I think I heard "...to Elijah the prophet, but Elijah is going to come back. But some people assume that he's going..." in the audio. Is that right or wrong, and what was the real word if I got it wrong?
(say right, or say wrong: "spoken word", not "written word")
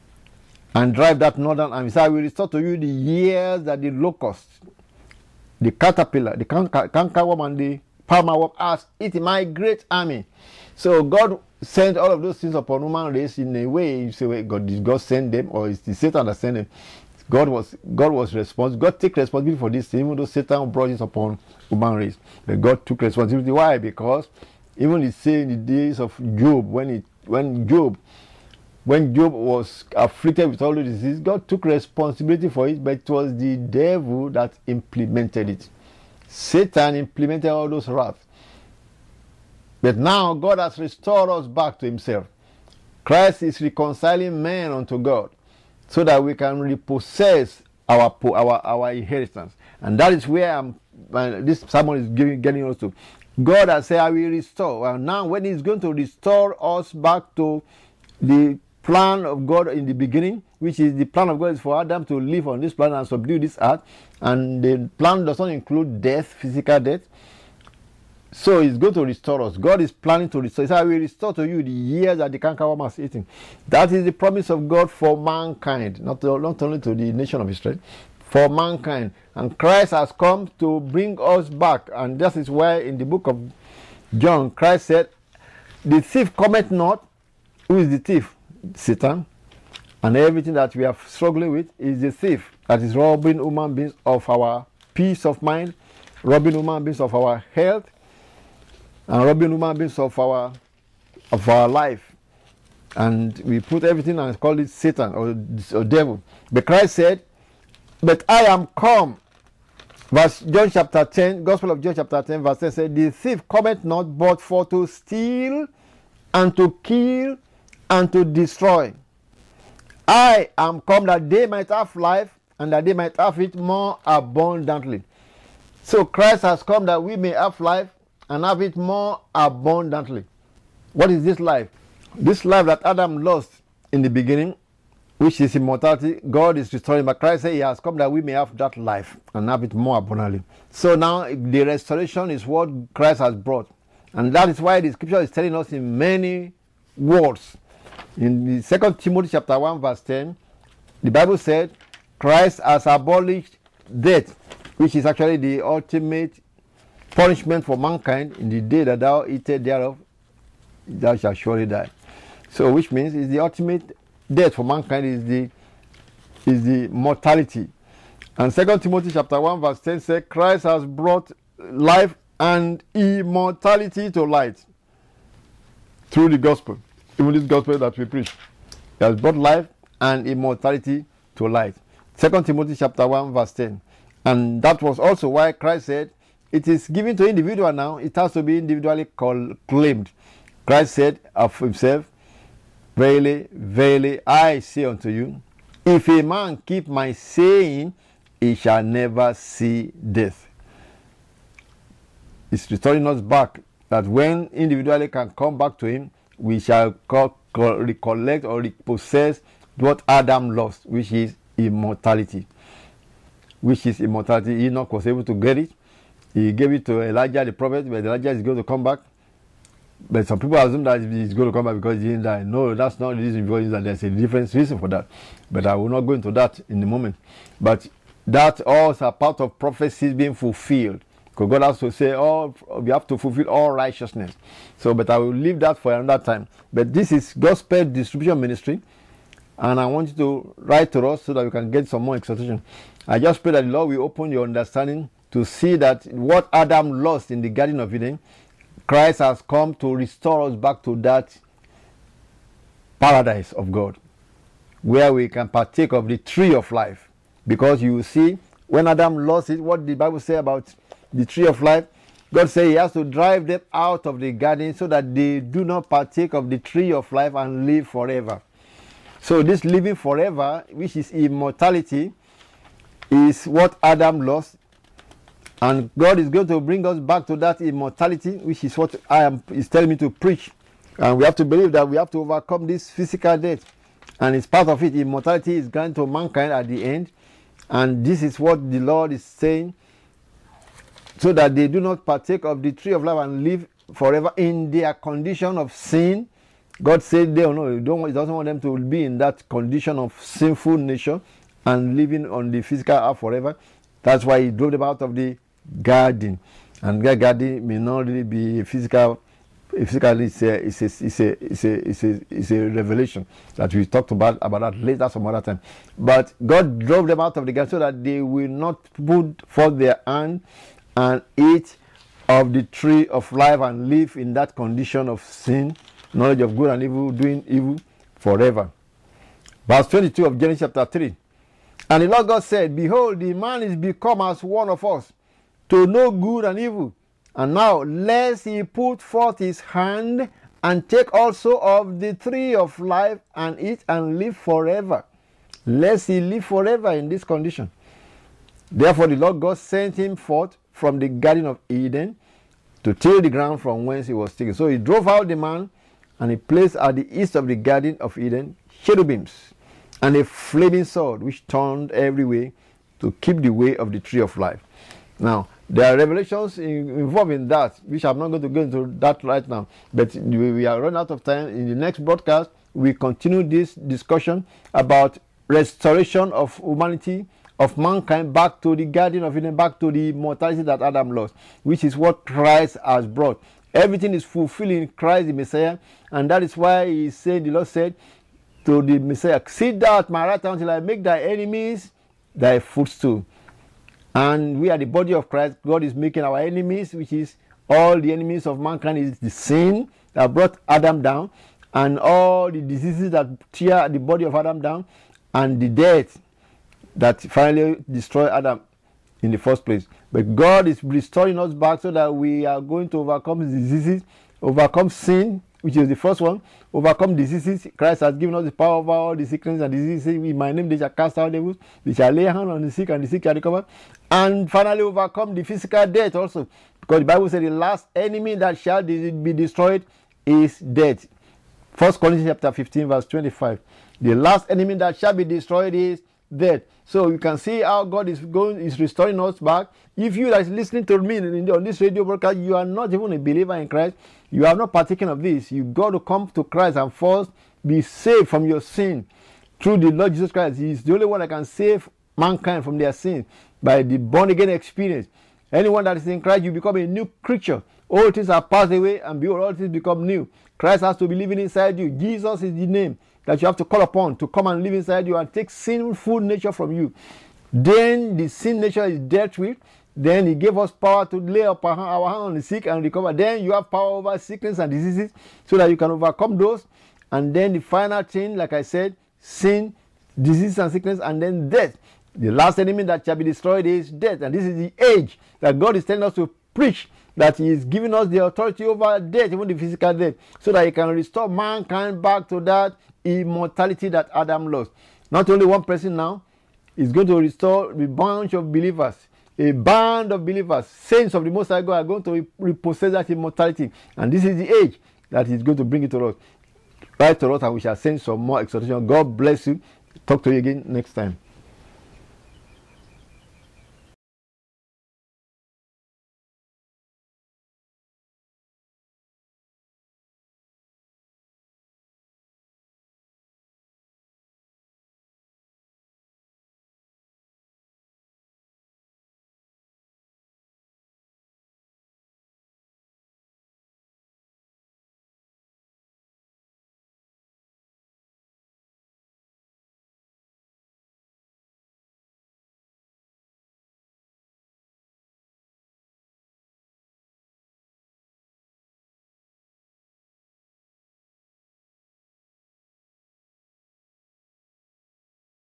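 right.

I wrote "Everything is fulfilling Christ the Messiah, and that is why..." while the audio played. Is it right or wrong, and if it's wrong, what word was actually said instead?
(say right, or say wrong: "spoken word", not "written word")
right.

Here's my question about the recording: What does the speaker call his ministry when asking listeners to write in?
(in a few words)
Gospel distribution ministry.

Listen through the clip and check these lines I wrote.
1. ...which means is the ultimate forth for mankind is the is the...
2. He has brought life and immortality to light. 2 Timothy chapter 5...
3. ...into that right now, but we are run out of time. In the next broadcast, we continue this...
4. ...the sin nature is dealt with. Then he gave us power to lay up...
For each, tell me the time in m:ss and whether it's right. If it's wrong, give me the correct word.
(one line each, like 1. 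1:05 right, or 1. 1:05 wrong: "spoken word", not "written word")
1. 2:42 wrong: "death", not "forth"
2. 2:58 wrong: "1", not "5"
3. 6:08 right
4. 7:48 right.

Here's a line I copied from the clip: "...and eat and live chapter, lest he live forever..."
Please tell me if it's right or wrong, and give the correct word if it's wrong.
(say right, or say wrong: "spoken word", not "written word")
wrong: "forever", not "chapter".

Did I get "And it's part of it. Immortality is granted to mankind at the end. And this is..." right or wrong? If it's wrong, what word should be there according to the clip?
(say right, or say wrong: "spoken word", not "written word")
right.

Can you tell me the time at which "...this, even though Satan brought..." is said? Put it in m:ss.
0:19.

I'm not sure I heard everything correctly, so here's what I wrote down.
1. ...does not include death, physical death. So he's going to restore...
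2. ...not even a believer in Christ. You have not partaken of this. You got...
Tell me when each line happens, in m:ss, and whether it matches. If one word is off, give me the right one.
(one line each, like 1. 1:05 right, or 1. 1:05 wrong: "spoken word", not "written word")
1. 1:05 right
2. 7:22 right.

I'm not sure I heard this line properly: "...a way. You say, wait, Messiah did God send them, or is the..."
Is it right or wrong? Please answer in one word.
wrong.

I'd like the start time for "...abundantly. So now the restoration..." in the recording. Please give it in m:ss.
2:19.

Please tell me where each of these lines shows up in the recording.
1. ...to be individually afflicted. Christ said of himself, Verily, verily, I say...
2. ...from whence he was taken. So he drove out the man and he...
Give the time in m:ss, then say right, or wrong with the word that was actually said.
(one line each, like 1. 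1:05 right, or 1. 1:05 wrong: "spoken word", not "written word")
1. 3:08 wrong: "claimed", not "afflicted"
2. 5:53 right.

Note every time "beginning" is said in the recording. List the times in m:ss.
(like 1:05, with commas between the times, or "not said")
0:59, 2:14.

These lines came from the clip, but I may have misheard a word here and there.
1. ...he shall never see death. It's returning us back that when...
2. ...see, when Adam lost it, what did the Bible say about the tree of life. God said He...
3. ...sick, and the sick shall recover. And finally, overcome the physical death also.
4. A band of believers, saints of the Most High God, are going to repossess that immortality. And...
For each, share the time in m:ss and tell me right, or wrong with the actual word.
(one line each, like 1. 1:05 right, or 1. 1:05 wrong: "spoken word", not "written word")
1. 3:18 right
2. 4:18 right
3. 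7:02 right
4. 8:19 right.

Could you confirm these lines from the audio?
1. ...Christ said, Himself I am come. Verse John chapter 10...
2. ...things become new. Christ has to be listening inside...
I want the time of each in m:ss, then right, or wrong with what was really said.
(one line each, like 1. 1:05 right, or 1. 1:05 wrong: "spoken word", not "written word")
1. 1:46 wrong: "But", not "Himself"
2. 7:39 wrong: "living", not "listening".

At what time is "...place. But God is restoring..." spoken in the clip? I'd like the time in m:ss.
6:49.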